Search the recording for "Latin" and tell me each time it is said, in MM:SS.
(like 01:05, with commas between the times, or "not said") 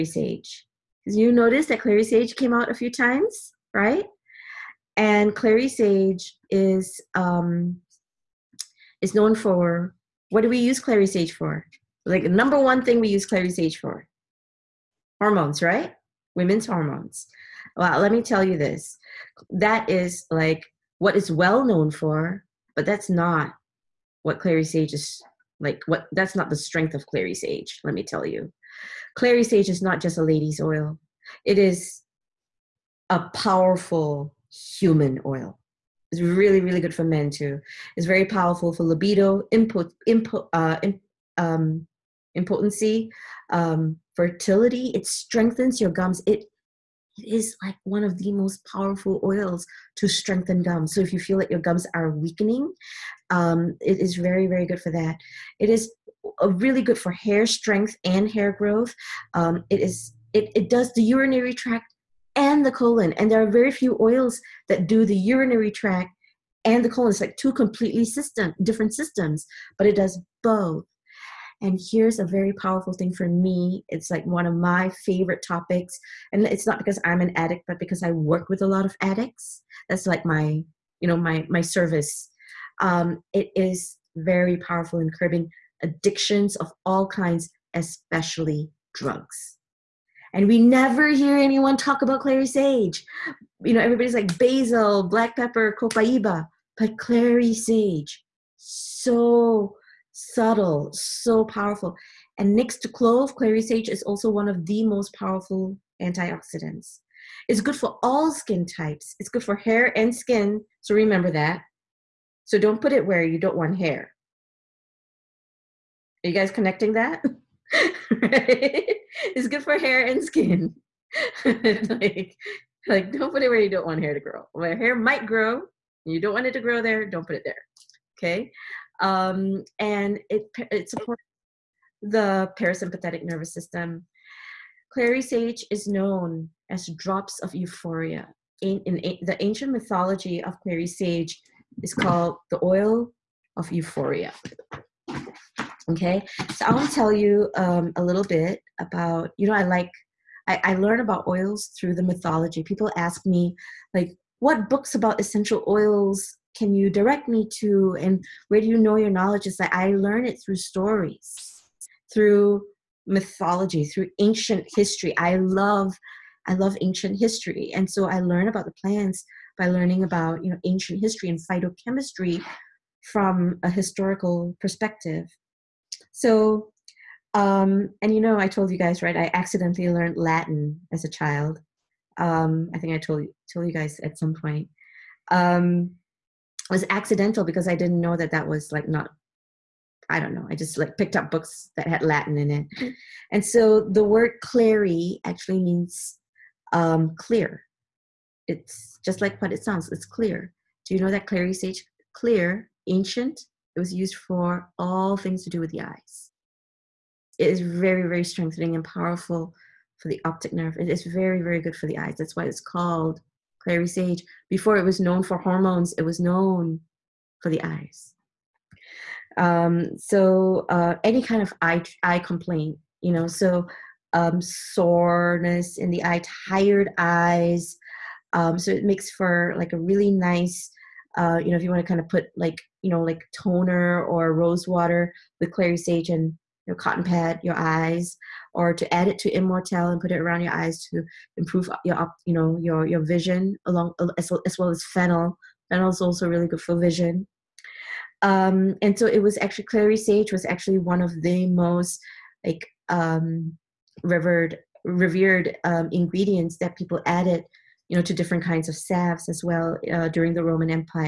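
03:00, 03:12.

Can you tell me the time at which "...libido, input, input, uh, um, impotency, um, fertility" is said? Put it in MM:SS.
00:38.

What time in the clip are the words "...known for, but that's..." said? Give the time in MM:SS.
00:21.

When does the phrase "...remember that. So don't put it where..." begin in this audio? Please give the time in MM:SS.
01:50.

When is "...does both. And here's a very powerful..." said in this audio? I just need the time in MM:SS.
01:09.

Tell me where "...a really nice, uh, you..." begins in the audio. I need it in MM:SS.
03:49.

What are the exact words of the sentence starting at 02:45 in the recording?
I love, I love ancient history.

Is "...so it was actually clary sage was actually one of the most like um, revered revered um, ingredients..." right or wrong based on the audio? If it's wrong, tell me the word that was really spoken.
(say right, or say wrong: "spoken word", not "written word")
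right.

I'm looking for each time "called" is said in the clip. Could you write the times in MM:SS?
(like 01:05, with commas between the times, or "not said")
02:21, 03:32.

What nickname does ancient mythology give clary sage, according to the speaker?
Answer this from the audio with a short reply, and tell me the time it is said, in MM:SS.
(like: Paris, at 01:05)
Oil of euphoria, at 02:22.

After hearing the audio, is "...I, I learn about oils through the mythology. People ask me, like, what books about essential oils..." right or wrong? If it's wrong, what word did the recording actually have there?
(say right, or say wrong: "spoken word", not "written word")
right.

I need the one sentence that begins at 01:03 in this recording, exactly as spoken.
And there are very few oils that do the urinary tract and the colon.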